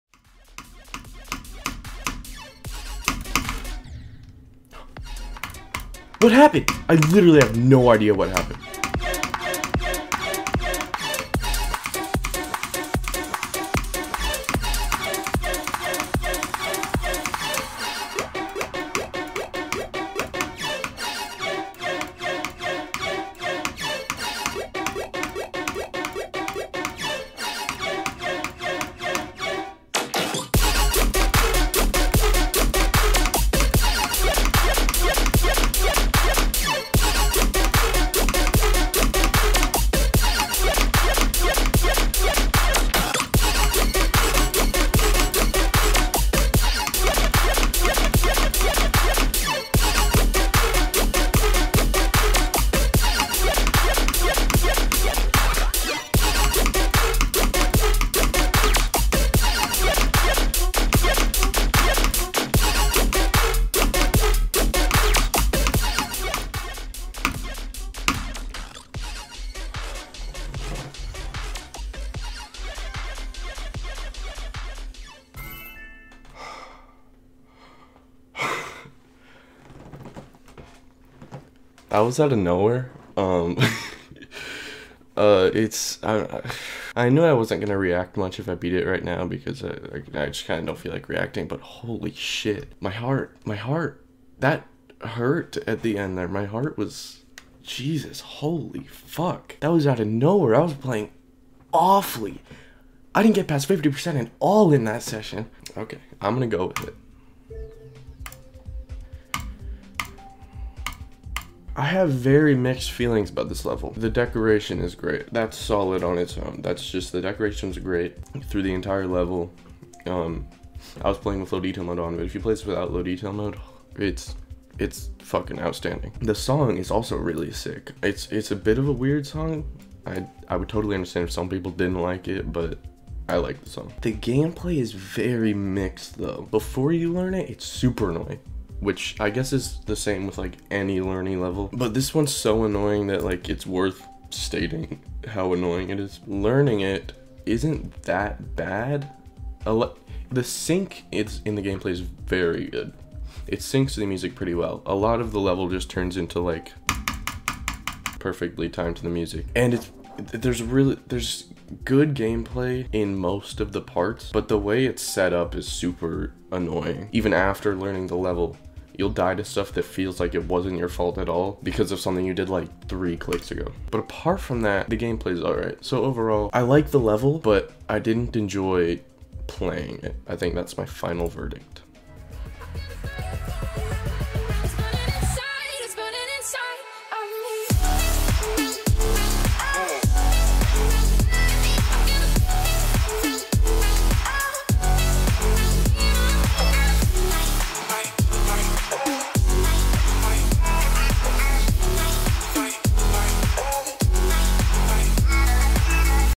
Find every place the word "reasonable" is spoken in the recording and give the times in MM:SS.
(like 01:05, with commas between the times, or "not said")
not said.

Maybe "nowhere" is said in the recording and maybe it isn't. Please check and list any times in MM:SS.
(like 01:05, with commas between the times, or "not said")
01:22, 01:40.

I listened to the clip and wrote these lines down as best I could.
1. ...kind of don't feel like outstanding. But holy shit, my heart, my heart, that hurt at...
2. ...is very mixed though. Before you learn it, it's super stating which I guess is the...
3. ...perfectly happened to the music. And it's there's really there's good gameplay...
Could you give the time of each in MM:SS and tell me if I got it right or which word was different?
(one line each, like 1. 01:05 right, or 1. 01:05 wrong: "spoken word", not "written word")
1. 01:30 wrong: "reacting", not "outstanding"
2. 02:14 wrong: "annoying", not "stating"
3. 02:38 wrong: "timed", not "happened".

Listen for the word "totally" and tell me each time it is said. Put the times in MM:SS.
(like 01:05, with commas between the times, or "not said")
02:10.